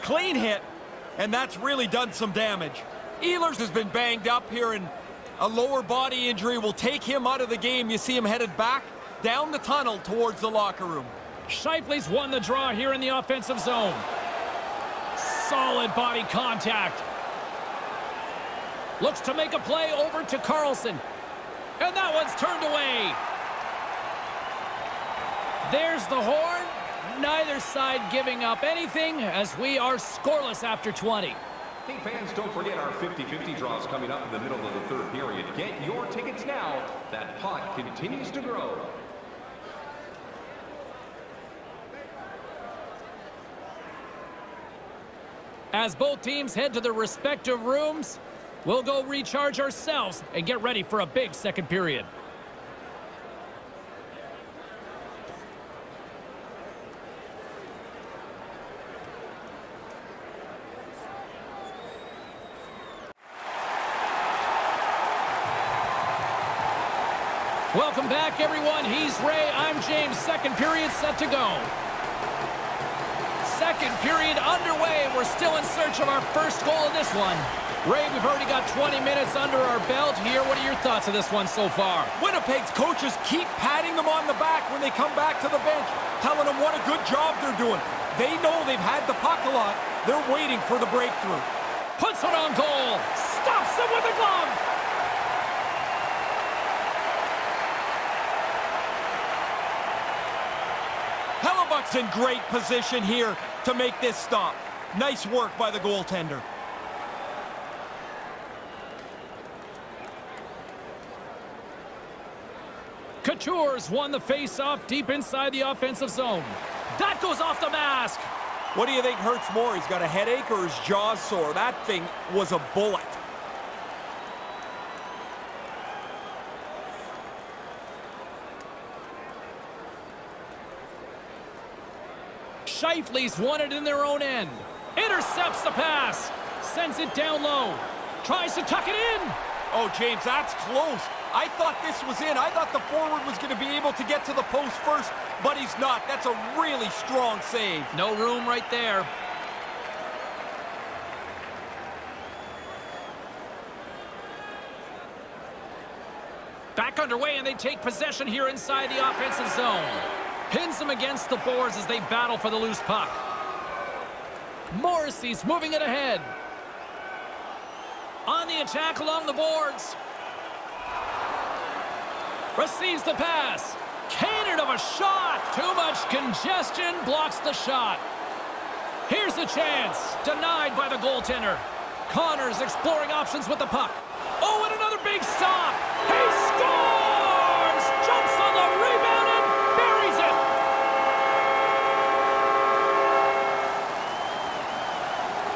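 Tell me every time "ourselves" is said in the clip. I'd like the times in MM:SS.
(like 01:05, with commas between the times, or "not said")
00:49.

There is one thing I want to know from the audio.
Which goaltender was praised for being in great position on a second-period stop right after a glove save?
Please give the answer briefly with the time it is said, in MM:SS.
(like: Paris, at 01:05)
Hellebuyck, at 01:41.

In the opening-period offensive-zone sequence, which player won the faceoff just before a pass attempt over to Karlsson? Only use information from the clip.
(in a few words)
Scheifele.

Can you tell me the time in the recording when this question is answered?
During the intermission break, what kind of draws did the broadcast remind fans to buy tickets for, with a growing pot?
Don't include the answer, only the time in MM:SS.
00:32.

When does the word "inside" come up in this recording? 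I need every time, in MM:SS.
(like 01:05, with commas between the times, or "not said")
01:55, 02:38.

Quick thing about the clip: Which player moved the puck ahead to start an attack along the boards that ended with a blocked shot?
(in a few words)
Morrissey.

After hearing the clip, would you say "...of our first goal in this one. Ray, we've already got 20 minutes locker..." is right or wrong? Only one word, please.
wrong.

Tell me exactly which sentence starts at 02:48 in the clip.
On the attack along the boards.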